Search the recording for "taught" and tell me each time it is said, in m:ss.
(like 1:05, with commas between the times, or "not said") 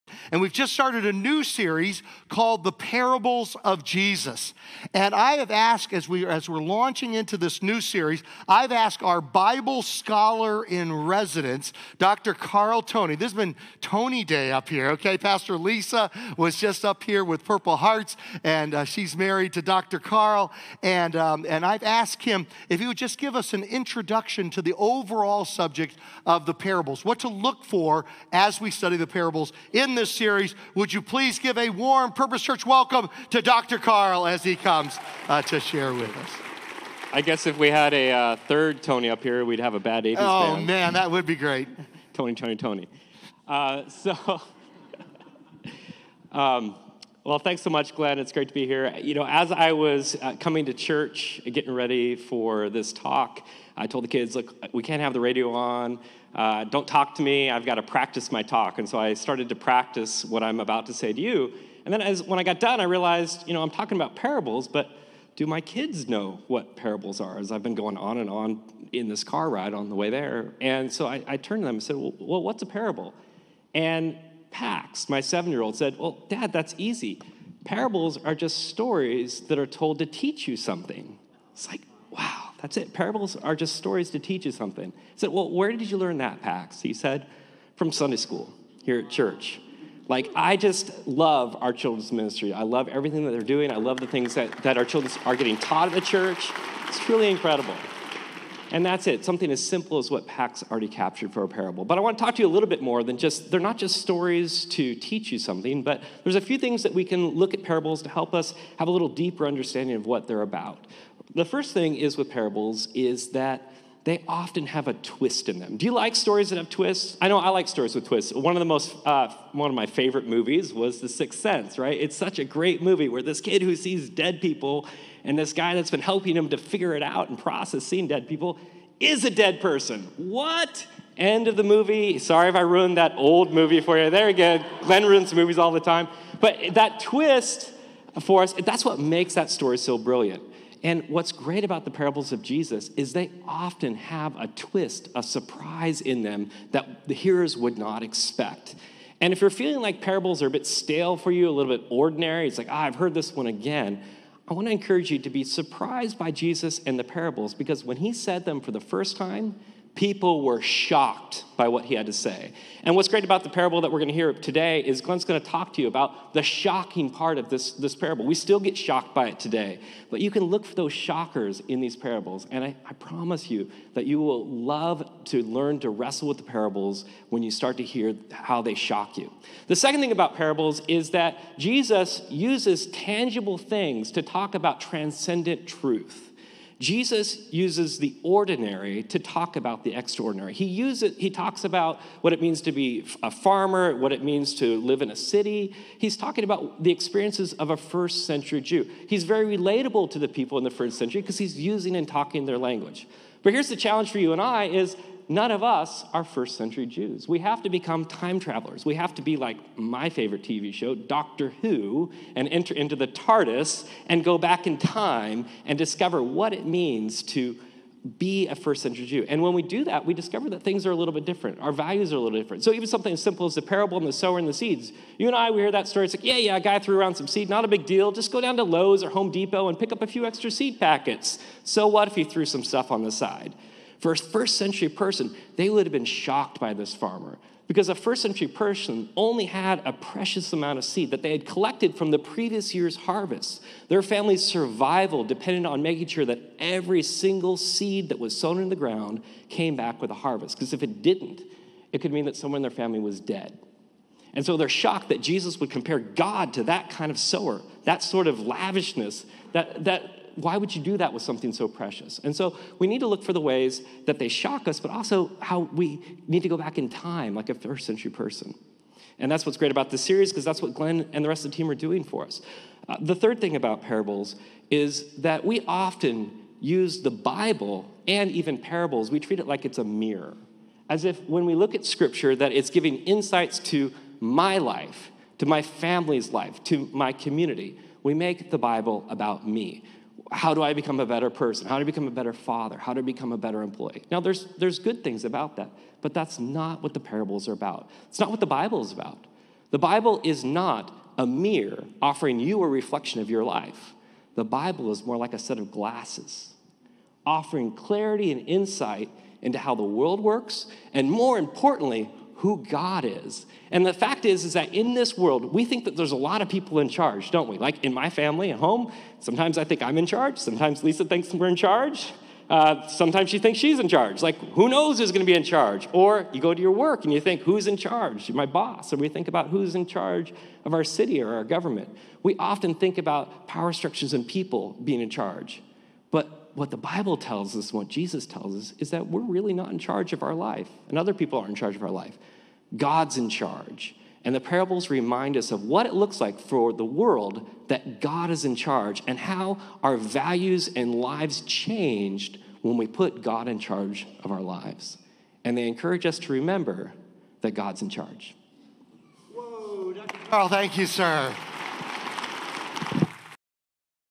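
1:35.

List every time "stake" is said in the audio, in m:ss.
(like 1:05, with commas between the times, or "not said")
not said.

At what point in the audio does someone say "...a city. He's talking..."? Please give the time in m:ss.
3:15.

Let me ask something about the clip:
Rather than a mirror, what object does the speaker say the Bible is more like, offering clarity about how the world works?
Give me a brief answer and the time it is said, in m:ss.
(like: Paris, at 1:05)
a set of glasses, at 5:05.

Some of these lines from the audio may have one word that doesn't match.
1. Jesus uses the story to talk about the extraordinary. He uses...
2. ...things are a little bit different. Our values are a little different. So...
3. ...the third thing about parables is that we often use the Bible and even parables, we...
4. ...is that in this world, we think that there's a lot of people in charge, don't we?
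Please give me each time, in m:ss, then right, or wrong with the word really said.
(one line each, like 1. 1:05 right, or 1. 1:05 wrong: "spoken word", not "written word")
1. 3:06 wrong: "ordinary", not "story"
2. 3:40 right
3. 4:32 right
4. 5:14 right.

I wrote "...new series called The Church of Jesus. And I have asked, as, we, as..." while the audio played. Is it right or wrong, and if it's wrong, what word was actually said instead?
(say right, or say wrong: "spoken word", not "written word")
wrong: "Parables", not "Church".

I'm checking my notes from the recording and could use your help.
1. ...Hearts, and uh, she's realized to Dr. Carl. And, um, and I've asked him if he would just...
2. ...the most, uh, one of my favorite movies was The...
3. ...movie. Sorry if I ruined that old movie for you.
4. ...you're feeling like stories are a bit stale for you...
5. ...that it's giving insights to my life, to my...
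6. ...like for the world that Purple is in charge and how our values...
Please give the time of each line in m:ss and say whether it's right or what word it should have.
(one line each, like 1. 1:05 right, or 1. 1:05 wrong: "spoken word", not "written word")
1. 0:17 wrong: "married", not "realized"
2. 1:58 right
3. 2:11 right
4. 2:29 wrong: "parables", not "stories"
5. 4:42 right
6. 5:46 wrong: "God", not "Purple".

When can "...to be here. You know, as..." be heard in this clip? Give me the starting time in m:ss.
0:48.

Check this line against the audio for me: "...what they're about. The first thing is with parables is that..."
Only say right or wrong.
right.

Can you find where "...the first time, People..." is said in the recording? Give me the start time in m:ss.
2:38.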